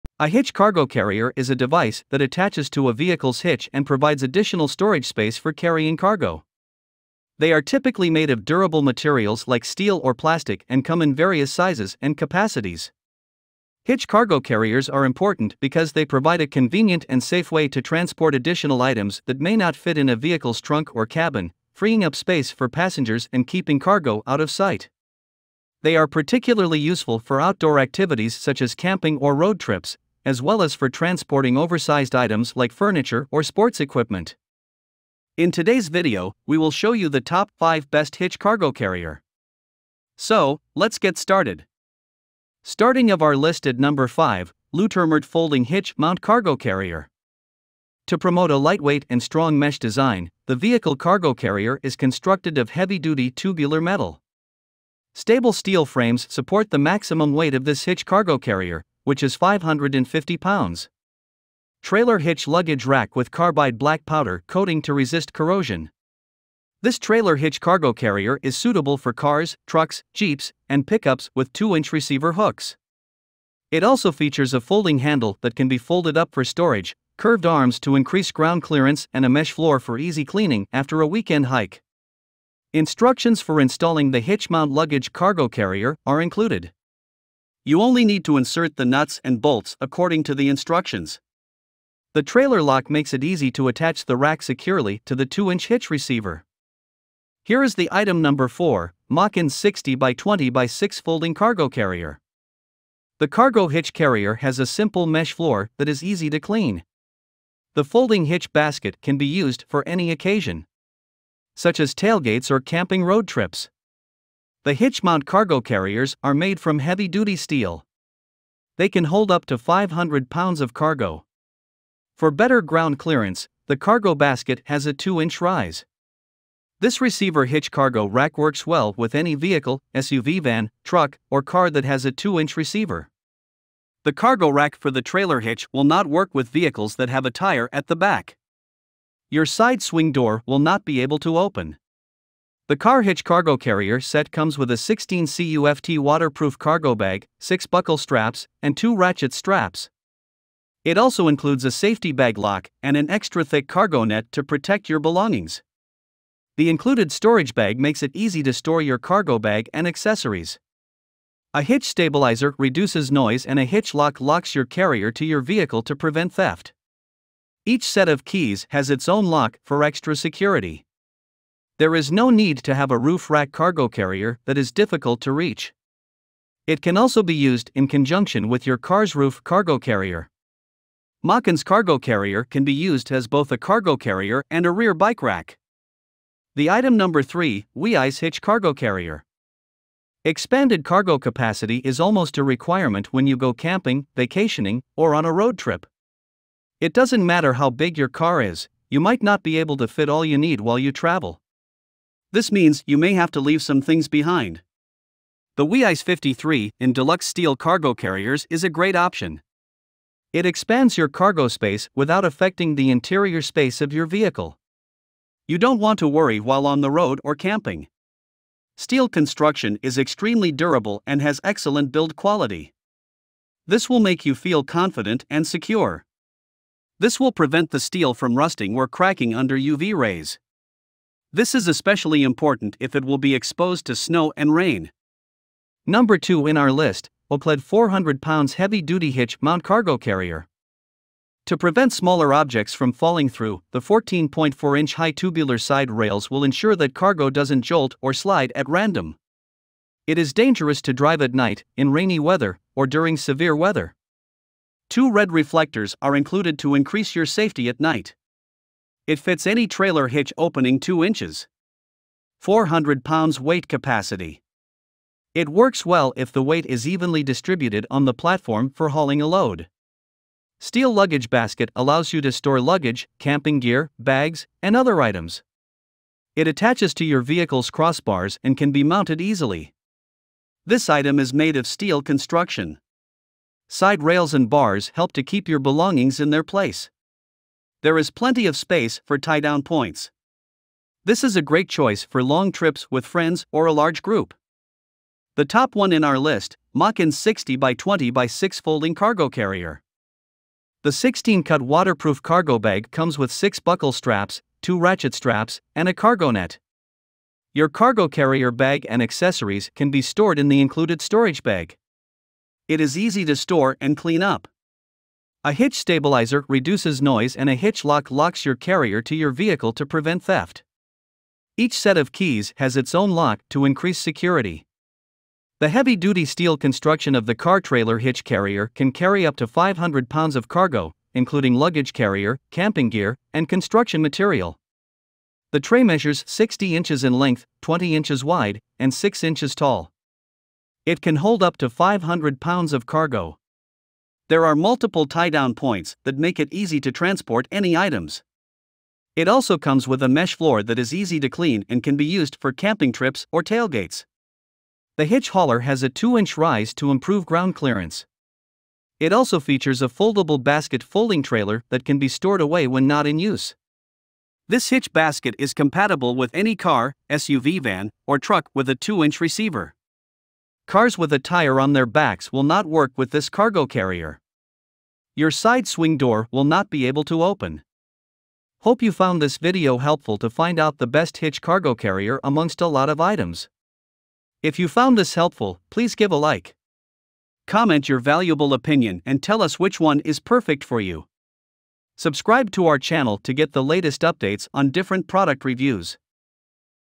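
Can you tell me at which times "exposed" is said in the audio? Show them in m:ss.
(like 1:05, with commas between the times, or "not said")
3:53.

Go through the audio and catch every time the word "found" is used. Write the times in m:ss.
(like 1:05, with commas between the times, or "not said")
6:18, 6:24.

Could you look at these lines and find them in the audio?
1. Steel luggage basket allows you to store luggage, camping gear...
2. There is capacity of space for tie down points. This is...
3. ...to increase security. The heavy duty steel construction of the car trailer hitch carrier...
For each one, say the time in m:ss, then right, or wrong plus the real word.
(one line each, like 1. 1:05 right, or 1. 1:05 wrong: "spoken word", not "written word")
1. 4:30 right
2. 4:47 wrong: "plenty", not "capacity"
3. 5:23 right.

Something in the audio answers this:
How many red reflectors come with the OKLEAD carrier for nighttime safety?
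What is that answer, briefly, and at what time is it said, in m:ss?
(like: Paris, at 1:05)
2, at 4:14.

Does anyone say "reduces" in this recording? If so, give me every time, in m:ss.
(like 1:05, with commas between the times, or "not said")
2:42, 5:16.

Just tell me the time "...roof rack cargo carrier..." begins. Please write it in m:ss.
2:52.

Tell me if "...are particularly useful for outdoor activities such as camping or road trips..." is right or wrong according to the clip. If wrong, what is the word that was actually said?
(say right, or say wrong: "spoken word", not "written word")
right.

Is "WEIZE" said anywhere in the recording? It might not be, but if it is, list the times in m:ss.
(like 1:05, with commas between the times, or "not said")
3:07, 3:25.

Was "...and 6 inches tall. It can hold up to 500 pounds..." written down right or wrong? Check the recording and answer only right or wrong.
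right.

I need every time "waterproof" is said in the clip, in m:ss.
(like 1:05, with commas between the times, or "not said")
2:25, 5:01.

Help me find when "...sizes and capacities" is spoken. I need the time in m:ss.
0:11.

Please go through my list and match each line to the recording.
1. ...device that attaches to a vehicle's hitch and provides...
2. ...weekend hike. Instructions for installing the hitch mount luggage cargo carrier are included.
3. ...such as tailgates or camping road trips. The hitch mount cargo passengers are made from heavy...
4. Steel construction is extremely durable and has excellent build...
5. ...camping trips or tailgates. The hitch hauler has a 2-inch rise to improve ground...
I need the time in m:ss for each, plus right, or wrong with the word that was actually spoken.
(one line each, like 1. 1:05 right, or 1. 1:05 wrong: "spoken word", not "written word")
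1. 0:01 right
2. 1:21 right
3. 1:51 wrong: "carriers", not "passengers"
4. 3:38 right
5. 5:52 right.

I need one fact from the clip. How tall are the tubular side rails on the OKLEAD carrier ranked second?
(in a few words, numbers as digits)
14.4 inches.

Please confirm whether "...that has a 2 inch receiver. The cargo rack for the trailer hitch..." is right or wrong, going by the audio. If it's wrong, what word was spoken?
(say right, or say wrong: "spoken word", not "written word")
right.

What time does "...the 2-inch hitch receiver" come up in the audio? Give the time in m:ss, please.
1:35.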